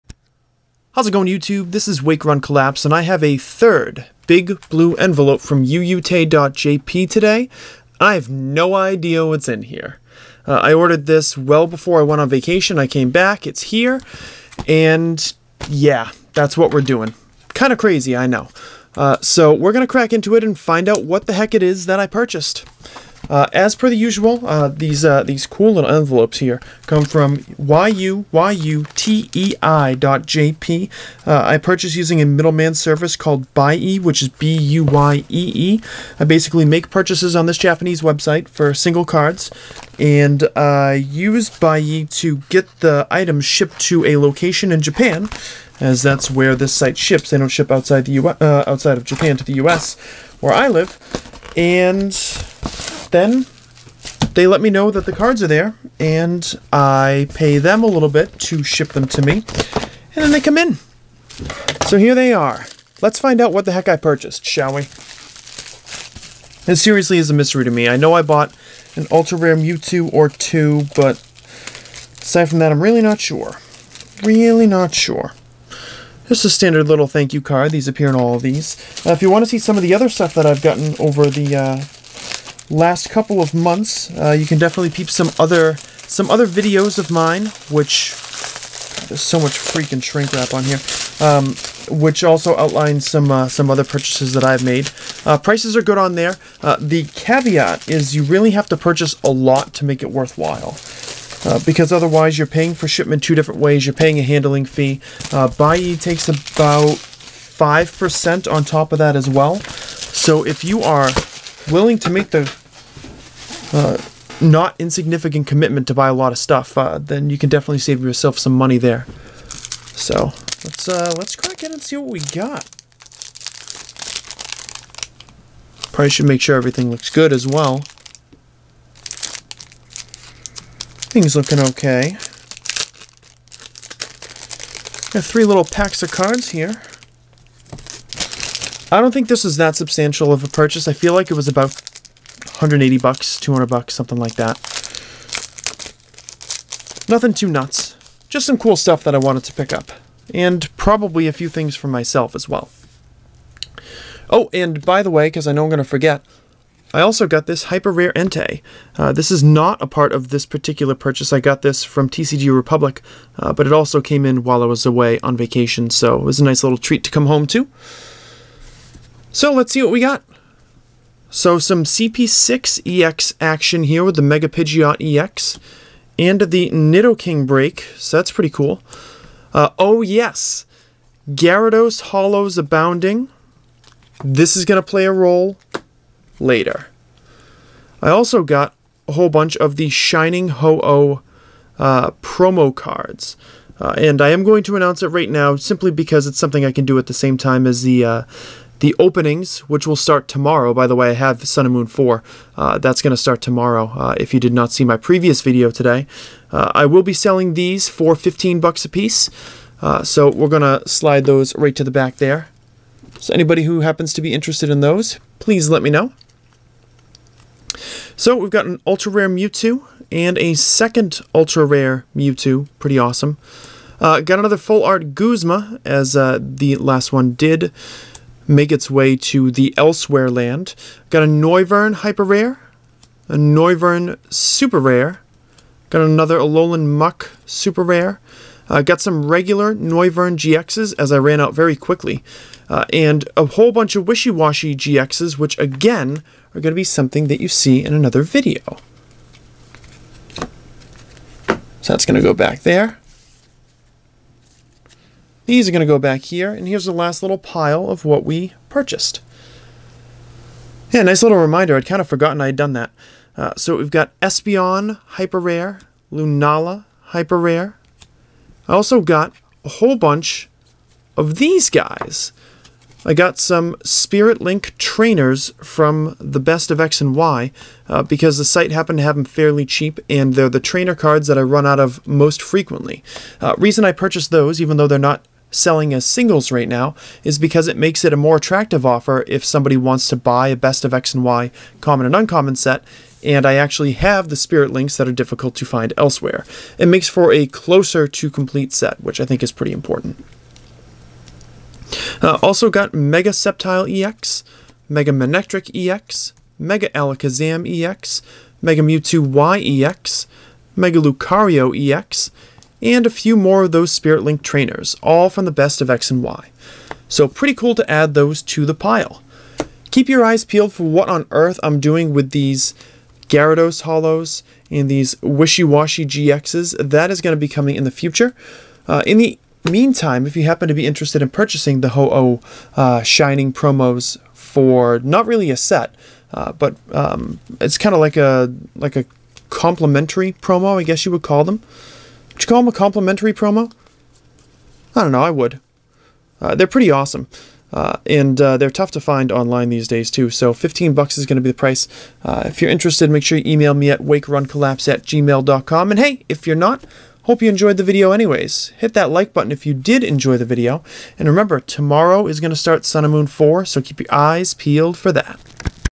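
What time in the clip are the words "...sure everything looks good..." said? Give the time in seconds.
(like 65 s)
126 s.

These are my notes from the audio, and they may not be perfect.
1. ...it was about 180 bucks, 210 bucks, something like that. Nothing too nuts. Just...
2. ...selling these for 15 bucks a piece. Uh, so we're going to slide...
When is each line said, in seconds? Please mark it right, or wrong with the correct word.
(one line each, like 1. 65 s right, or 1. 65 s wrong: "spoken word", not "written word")
1. 141 s wrong: "200", not "210"
2. 207 s right.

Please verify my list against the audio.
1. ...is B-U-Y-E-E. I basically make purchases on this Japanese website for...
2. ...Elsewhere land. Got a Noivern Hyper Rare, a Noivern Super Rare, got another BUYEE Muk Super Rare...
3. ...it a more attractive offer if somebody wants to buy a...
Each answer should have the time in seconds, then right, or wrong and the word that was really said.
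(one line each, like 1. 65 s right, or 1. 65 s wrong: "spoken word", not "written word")
1. 34 s right
2. 229 s wrong: "Alolan", not "BUYEE"
3. 288 s right.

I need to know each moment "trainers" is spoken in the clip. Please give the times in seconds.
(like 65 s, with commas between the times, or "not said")
274 s, 280 s, 314 s.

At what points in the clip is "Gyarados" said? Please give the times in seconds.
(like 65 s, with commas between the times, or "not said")
181 s, 323 s.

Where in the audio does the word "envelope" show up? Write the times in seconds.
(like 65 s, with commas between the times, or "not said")
4 s, 25 s.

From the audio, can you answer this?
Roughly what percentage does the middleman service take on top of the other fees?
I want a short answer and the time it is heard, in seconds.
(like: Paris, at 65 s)
5%, at 106 s.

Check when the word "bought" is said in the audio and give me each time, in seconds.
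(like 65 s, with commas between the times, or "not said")
68 s.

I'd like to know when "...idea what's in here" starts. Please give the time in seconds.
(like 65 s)
8 s.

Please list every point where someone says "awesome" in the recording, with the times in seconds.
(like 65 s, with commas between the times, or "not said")
222 s, 346 s.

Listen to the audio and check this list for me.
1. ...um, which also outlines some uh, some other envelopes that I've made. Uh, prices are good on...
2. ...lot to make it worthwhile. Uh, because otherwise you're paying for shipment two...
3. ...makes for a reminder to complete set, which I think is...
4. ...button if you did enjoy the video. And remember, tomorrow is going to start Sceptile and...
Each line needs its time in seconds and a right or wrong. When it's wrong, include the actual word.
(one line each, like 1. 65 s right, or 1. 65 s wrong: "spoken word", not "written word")
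1. 91 s wrong: "purchases", not "envelopes"
2. 99 s right
3. 296 s wrong: "closer", not "reminder"
4. 359 s wrong: "Sun", not "Sceptile".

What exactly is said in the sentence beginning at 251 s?
So that's going to go back there.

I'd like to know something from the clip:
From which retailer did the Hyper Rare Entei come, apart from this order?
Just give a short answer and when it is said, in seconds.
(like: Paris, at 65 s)
TCG Republic, at 162 s.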